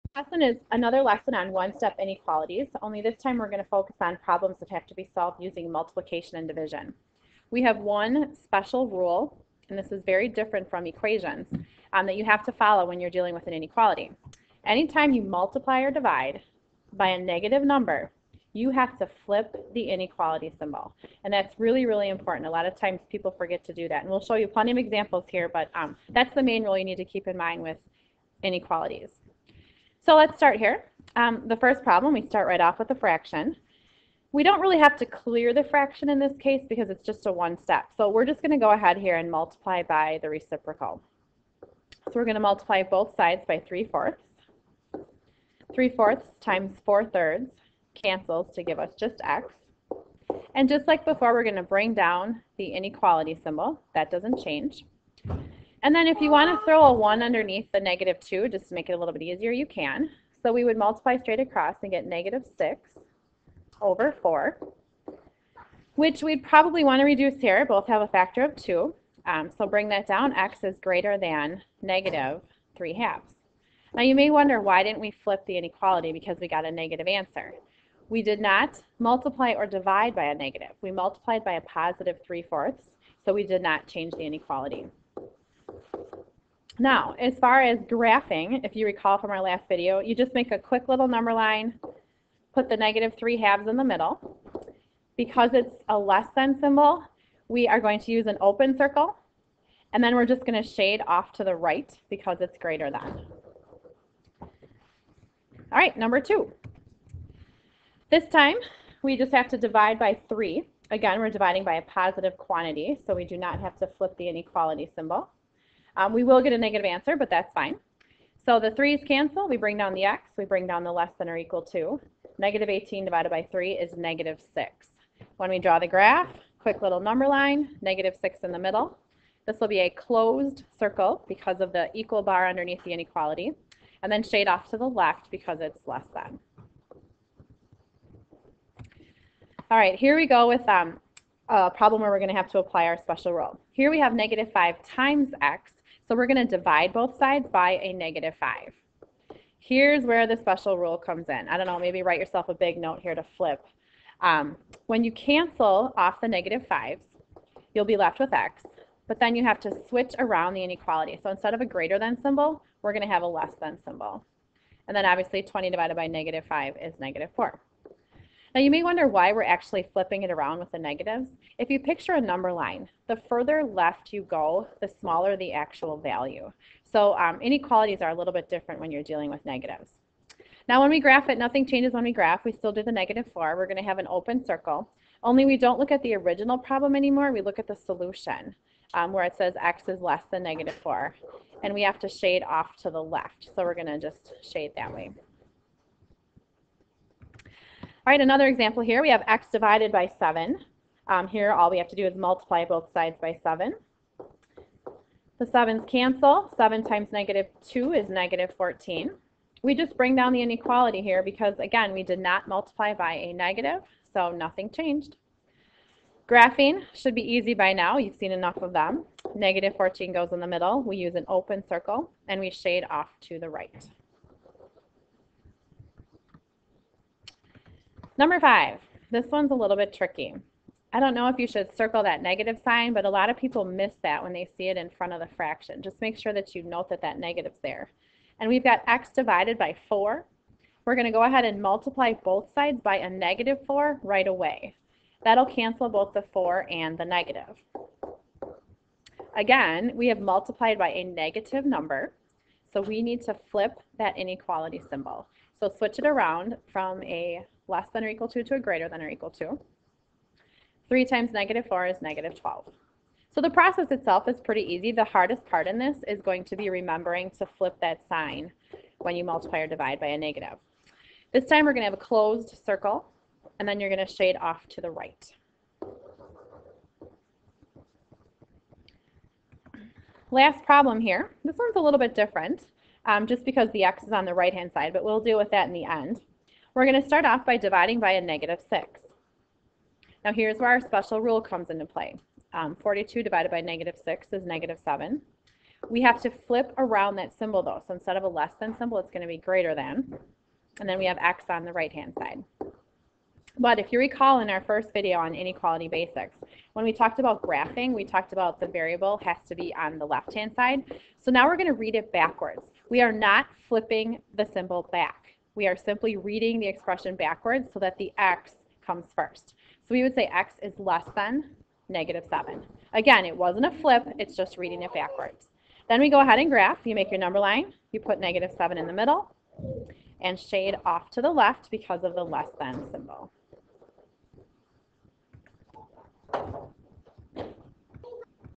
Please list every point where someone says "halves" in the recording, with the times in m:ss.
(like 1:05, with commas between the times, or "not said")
1:12, 1:33.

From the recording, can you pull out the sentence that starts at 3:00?
Now when we graph it, nothing changes when we graph.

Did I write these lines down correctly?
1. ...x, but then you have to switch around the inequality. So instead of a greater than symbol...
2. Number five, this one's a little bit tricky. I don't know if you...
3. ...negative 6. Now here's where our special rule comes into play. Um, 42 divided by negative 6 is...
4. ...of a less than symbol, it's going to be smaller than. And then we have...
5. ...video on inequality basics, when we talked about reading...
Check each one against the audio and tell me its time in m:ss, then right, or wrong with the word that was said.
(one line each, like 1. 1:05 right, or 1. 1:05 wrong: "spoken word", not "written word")
1. 2:38 right
2. 3:48 right
3. 4:48 right
4. 4:58 wrong: "greater", not "smaller"
5. 5:04 wrong: "graphing", not "reading".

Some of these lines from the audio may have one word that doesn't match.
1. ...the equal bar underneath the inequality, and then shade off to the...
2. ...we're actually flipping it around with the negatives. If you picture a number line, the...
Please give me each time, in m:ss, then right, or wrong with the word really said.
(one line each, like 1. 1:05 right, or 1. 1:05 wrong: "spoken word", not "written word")
1. 2:11 right
2. 2:49 right.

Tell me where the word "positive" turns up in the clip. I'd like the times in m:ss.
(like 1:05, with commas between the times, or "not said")
1:21, 1:51.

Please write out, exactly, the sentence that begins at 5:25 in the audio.
Then we go ahead and graph.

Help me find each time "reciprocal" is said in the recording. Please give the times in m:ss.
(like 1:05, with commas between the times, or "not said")
0:40.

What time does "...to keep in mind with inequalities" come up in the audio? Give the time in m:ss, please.
0:26.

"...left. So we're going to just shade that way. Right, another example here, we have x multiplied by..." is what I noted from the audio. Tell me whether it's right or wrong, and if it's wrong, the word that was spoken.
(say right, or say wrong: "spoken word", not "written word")
wrong: "divided", not "multiplied".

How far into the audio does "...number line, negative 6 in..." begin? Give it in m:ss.
2:06.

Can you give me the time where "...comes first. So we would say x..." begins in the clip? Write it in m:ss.
5:18.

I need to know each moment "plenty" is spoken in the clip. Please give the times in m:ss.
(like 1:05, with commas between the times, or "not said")
0:24.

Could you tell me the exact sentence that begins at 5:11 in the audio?
So now we're going to read it backwards.